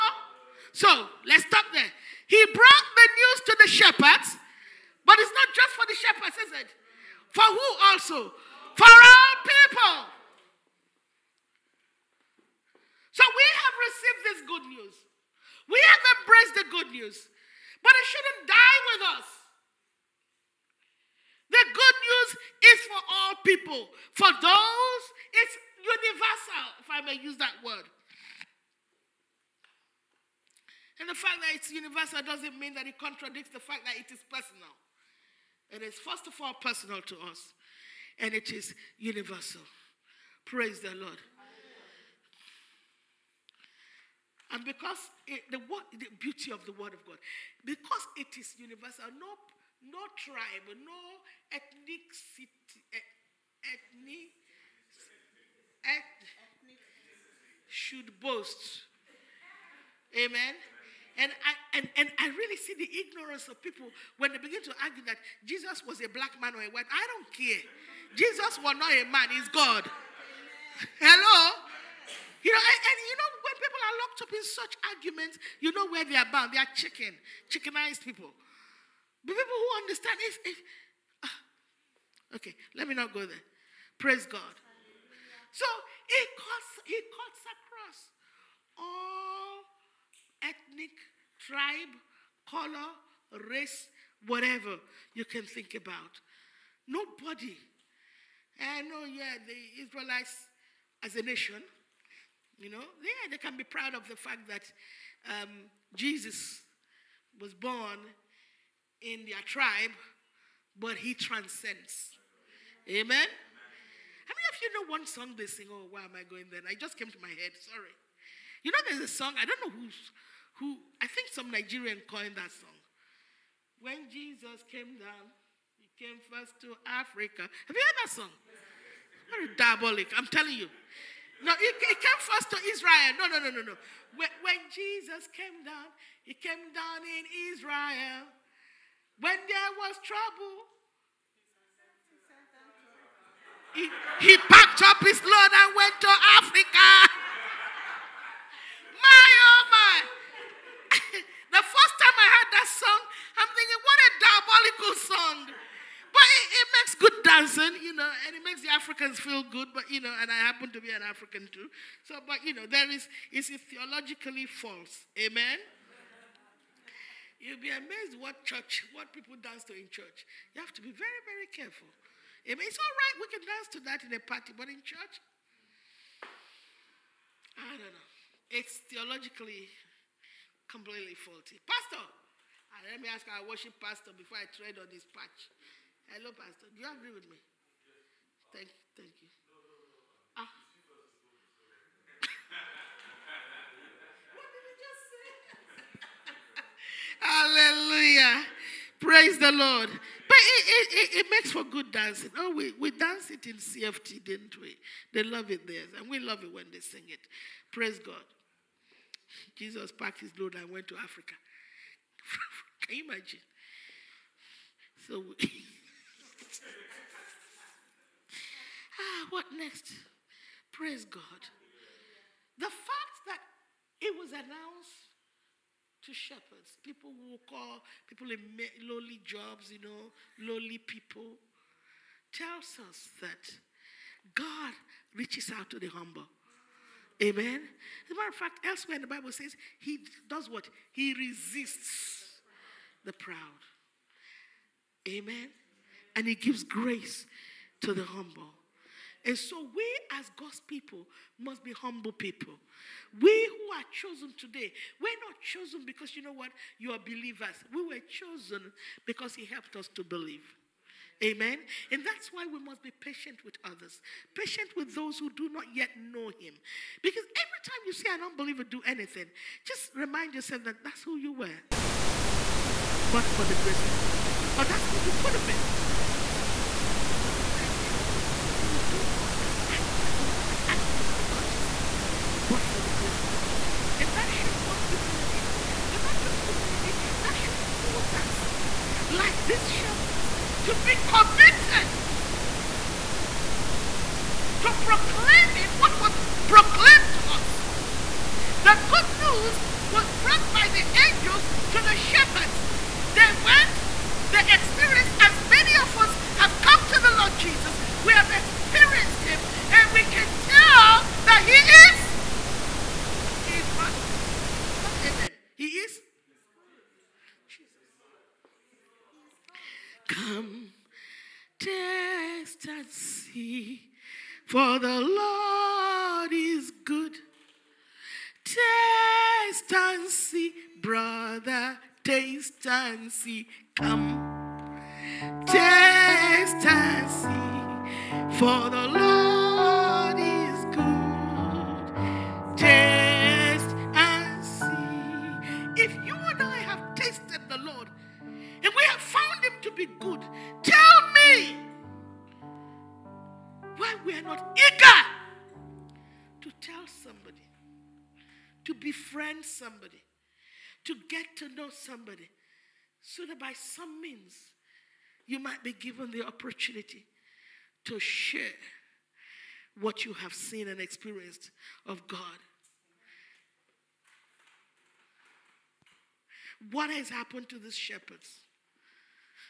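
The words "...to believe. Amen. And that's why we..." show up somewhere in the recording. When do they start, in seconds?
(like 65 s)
259 s.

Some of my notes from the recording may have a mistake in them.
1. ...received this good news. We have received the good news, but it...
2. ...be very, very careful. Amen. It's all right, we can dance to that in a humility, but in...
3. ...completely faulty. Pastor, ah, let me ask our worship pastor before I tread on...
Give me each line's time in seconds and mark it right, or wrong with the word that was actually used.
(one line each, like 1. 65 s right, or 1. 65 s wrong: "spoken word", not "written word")
1. 13 s wrong: "embraced", not "received"
2. 170 s wrong: "party", not "humility"
3. 180 s right.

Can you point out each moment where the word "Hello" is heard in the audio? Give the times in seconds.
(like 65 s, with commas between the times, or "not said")
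71 s, 186 s.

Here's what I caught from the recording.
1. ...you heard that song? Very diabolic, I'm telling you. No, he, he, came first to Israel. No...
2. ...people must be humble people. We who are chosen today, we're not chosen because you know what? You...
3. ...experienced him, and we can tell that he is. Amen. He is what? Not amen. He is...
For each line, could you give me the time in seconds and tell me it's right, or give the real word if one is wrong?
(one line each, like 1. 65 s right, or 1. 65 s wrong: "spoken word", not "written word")
1. 127 s right
2. 250 s right
3. 308 s right.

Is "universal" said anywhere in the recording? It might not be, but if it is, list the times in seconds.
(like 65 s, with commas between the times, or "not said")
25 s, 31 s, 38 s, 48 s.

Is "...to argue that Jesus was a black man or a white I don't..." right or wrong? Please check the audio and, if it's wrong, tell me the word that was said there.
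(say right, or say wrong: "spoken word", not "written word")
right.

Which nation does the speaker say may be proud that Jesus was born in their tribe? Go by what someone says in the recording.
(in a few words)
Israelites.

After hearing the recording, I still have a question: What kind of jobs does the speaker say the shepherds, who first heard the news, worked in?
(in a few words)
lowly jobs.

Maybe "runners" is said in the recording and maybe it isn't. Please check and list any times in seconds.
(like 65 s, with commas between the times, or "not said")
not said.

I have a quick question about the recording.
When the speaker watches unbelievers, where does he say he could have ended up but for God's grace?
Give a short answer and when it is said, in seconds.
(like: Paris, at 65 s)
the gutters, at 281 s.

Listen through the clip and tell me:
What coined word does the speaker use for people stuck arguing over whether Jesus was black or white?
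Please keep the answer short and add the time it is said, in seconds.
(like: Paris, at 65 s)
chickenized, at 77 s.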